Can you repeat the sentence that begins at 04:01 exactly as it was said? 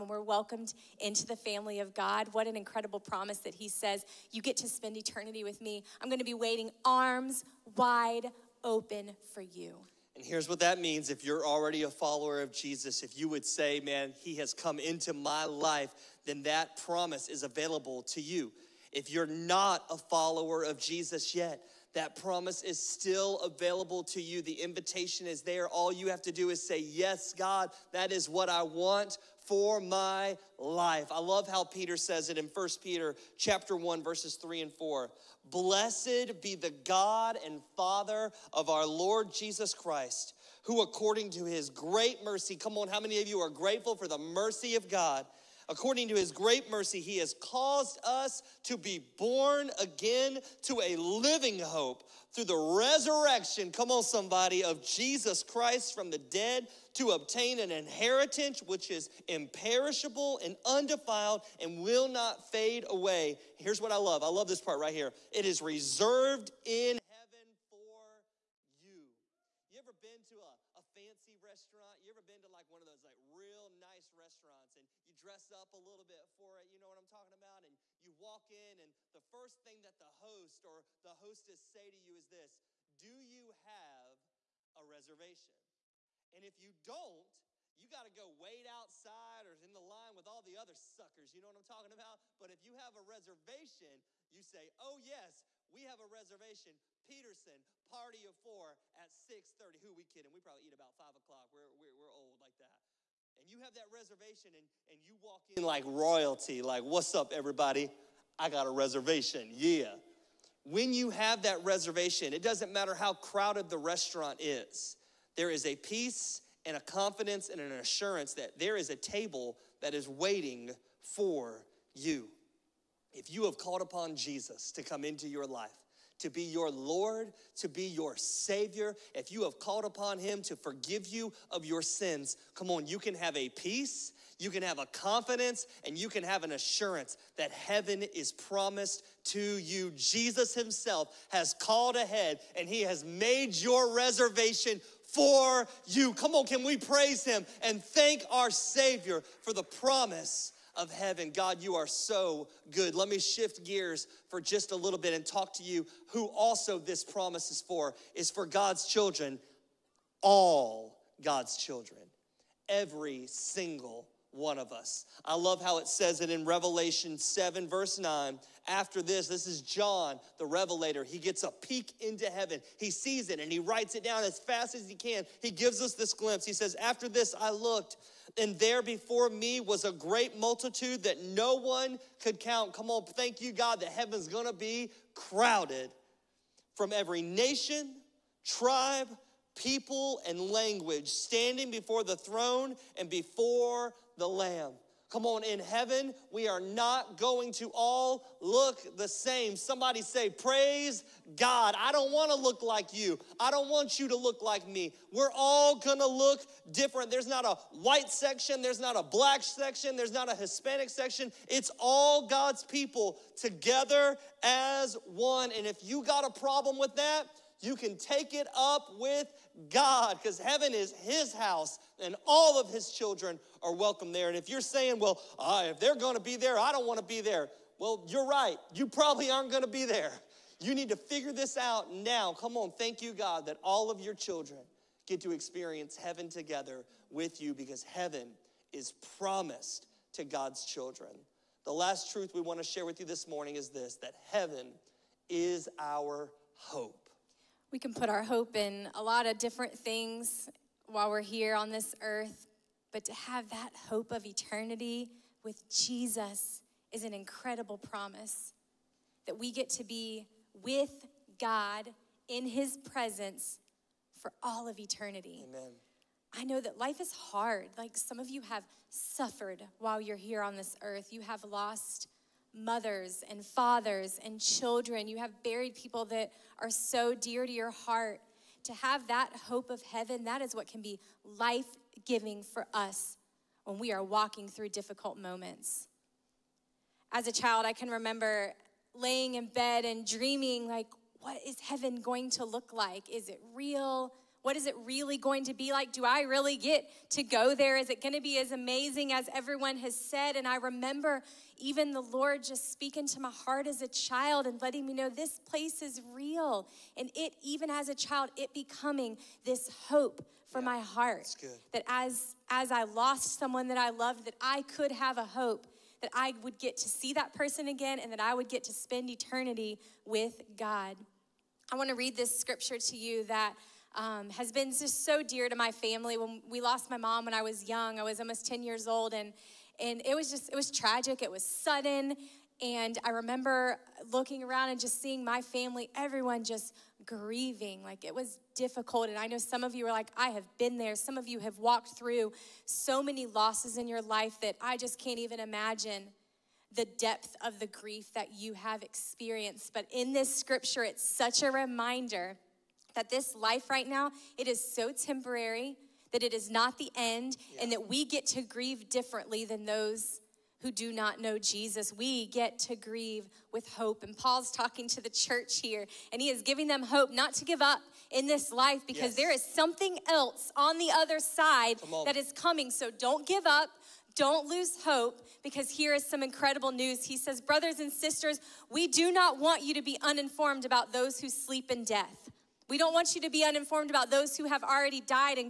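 The last truth we want to share with you this morning is this that heaven is our hope.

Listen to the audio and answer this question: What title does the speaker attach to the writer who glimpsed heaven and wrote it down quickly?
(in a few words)
John the Revelator.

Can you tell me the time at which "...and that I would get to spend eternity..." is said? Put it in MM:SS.
05:18.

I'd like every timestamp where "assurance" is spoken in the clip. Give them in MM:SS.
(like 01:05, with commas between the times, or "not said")
01:57, 02:16.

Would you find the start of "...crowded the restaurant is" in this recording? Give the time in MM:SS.
01:53.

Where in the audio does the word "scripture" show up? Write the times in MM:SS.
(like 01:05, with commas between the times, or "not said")
05:22, 05:50.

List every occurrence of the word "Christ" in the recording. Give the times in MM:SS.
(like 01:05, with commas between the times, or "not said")
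00:39, 00:55.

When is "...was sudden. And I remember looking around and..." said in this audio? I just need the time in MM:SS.
05:31.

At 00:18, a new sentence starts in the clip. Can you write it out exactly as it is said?
If you're not a follower of Jesus yet, that promise is still available to you.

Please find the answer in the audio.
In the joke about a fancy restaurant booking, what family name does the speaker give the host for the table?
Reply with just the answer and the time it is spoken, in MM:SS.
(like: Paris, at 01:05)
Peterson, at 01:37.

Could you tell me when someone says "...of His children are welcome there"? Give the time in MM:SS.
03:42.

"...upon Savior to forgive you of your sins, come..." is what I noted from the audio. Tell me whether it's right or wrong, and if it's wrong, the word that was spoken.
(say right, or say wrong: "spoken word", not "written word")
wrong: "Him", not "Savior".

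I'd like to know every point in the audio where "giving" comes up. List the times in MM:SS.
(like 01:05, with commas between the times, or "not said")
04:42, 06:06.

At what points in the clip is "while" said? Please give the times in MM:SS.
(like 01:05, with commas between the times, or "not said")
04:10, 04:29.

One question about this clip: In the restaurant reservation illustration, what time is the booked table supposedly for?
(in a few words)
6:30.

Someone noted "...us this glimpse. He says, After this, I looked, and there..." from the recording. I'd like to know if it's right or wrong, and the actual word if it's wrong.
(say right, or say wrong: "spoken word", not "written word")
right.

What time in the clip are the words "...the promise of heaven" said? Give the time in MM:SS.
02:29.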